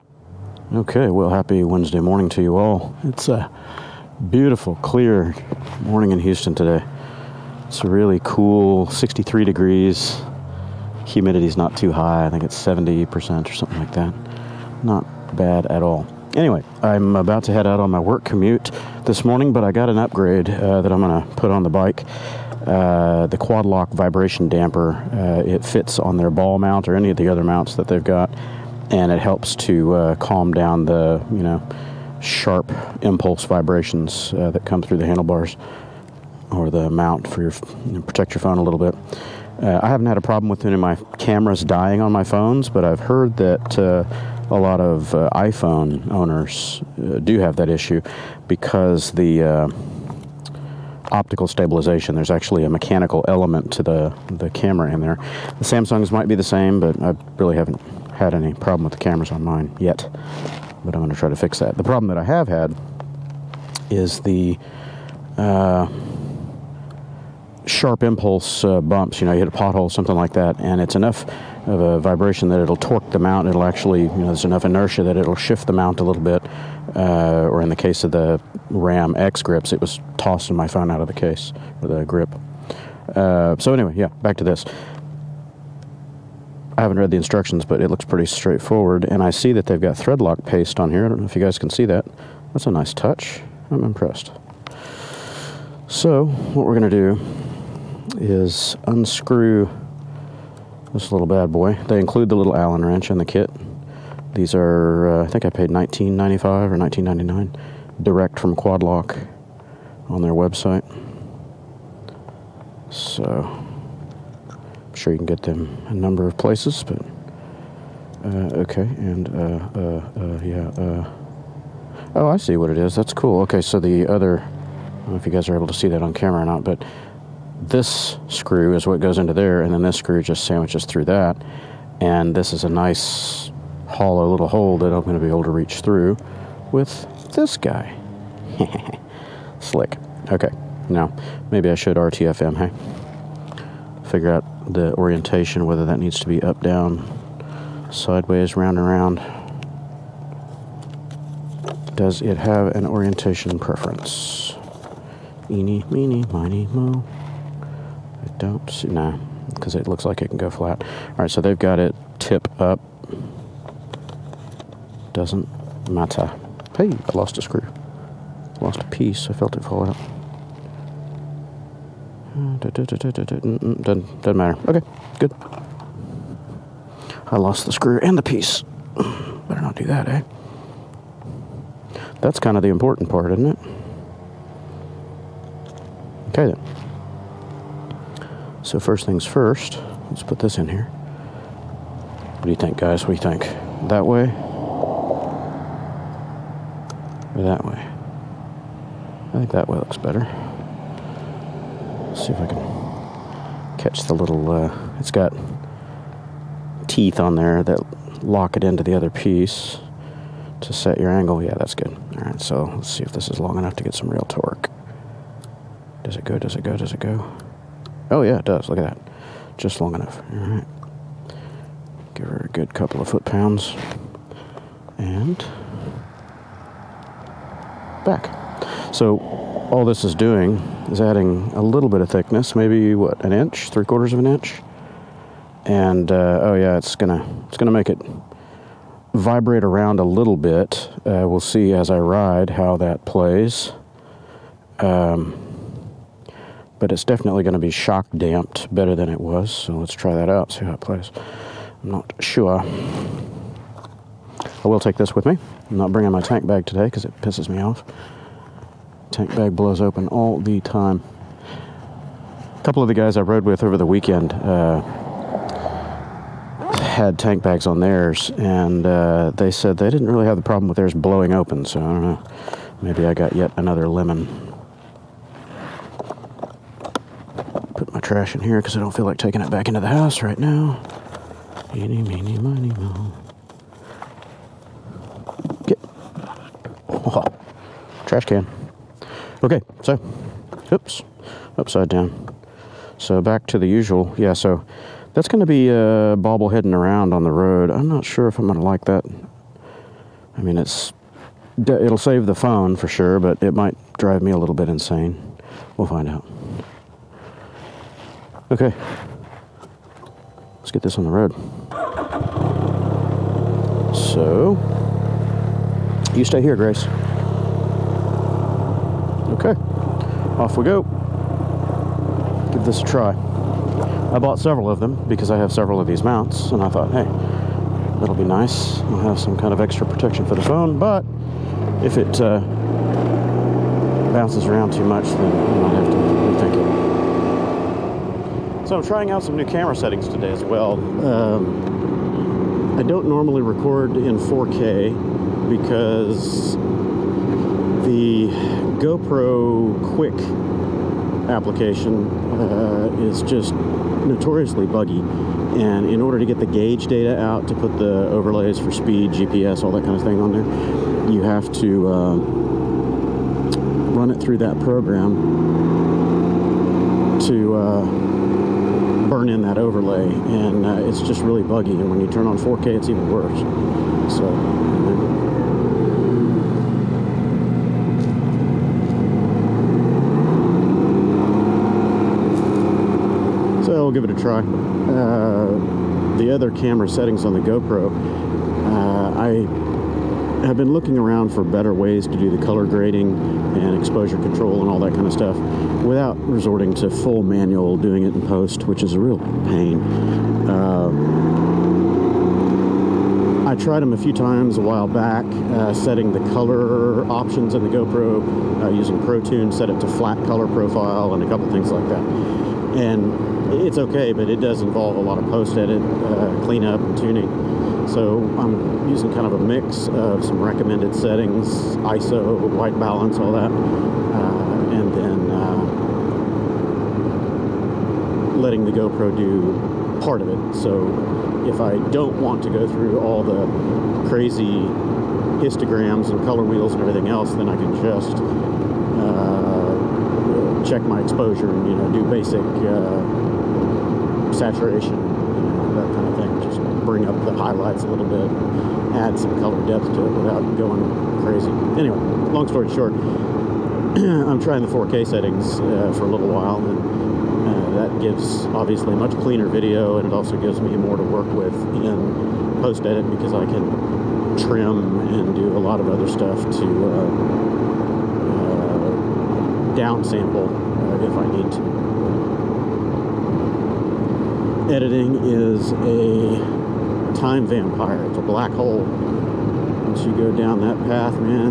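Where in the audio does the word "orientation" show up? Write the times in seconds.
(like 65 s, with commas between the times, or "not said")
144 s, 152 s.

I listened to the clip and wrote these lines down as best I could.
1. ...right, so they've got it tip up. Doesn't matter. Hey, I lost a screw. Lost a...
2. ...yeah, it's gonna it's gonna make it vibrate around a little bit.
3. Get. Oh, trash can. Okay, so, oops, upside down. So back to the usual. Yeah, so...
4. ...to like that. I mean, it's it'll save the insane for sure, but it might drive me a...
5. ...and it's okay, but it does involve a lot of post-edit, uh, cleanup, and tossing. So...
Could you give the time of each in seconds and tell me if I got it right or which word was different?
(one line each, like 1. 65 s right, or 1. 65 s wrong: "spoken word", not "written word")
1. 161 s right
2. 236 s right
3. 285 s right
4. 298 s wrong: "phone", not "insane"
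5. 412 s wrong: "tuning", not "tossing".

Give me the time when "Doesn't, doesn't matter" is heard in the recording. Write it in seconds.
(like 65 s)
172 s.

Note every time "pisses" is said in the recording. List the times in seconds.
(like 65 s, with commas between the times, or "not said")
257 s.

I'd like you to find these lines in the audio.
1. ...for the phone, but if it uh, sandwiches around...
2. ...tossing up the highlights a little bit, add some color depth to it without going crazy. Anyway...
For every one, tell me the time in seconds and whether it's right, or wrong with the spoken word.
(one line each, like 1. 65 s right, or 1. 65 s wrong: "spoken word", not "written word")
1. 330 s wrong: "bounces", not "sandwiches"
2. 446 s wrong: "bring", not "tossing".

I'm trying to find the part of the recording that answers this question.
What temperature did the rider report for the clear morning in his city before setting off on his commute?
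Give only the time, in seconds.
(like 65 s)
8 s.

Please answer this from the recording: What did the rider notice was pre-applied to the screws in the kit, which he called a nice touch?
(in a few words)
Thread lock paste.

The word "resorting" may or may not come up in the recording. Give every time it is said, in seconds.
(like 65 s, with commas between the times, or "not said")
396 s.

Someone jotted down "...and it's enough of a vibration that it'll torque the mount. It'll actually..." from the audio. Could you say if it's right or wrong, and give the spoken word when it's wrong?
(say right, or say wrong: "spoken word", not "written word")
right.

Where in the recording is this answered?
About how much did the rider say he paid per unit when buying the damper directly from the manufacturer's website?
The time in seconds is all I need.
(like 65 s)
105 s.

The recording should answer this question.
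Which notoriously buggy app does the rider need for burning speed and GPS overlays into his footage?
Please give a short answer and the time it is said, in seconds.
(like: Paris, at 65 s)
GoPro Quick, at 348 s.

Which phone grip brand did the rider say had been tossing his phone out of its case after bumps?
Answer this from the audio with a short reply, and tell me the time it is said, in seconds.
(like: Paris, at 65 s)
Ram X grips, at 78 s.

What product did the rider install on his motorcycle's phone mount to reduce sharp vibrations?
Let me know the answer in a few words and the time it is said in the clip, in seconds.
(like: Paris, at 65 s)
Quad Lock vibration damper, at 23 s.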